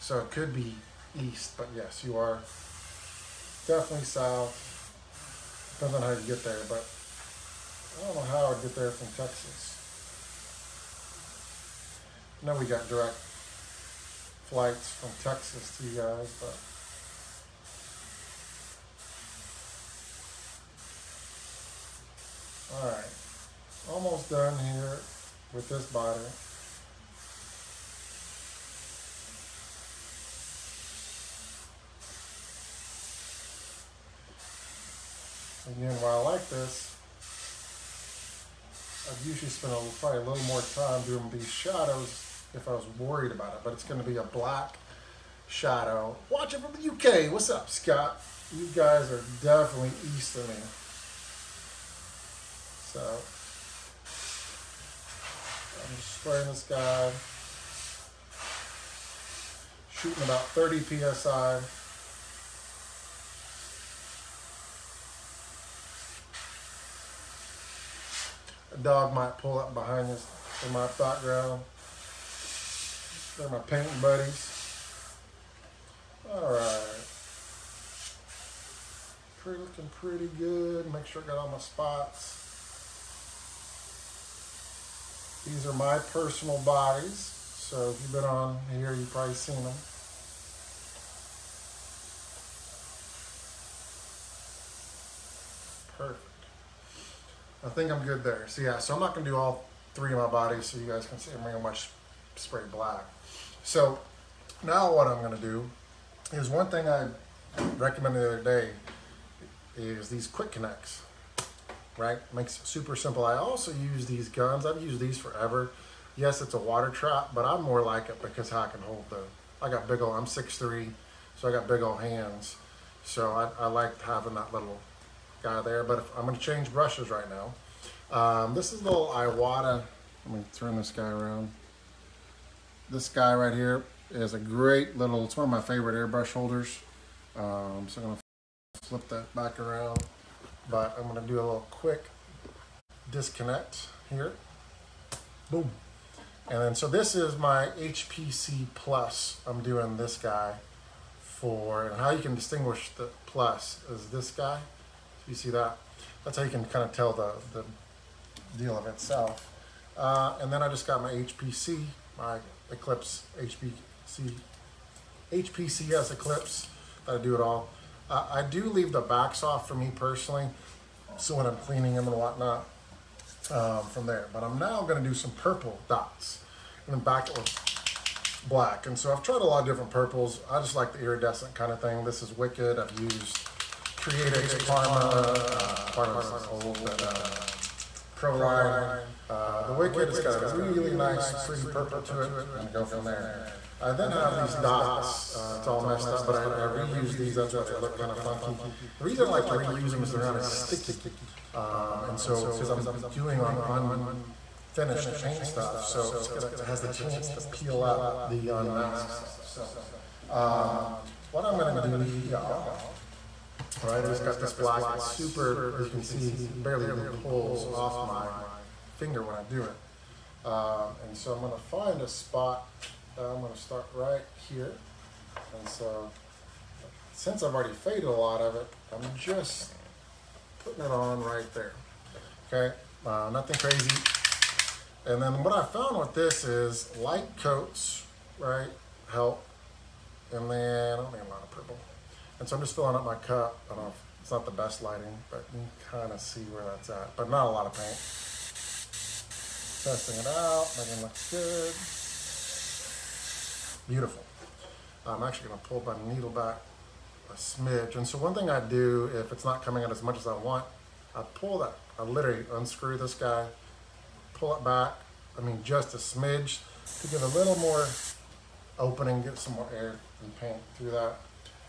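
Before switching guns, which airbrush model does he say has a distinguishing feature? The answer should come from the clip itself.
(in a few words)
HPC Plus.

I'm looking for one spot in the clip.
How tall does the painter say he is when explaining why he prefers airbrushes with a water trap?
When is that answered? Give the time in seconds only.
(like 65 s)
120 s.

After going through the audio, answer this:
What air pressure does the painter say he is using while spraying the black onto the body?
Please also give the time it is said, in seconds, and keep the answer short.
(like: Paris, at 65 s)
30 PSI, at 60 s.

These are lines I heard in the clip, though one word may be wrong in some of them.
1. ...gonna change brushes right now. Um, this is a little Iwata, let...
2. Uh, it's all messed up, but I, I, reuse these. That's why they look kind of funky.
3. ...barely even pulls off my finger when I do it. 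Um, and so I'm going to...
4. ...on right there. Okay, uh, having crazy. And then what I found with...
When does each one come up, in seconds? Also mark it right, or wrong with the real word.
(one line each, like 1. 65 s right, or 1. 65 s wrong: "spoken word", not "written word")
1. 126 s right
2. 195 s right
3. 216 s right
4. 230 s wrong: "nothing", not "having".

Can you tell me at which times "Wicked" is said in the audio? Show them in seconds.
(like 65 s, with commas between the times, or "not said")
182 s, 189 s.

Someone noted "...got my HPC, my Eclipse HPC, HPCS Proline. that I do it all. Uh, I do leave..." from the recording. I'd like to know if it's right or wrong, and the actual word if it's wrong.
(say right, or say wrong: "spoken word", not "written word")
wrong: "Eclipse", not "Proline".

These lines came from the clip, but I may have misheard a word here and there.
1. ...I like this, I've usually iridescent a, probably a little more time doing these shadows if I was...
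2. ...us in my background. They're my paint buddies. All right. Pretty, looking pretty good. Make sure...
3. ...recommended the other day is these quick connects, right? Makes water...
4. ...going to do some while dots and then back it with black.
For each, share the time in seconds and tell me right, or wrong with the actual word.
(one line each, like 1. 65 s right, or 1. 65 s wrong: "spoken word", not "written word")
1. 36 s wrong: "spent", not "iridescent"
2. 70 s right
3. 107 s wrong: "super", not "water"
4. 174 s wrong: "purple", not "while".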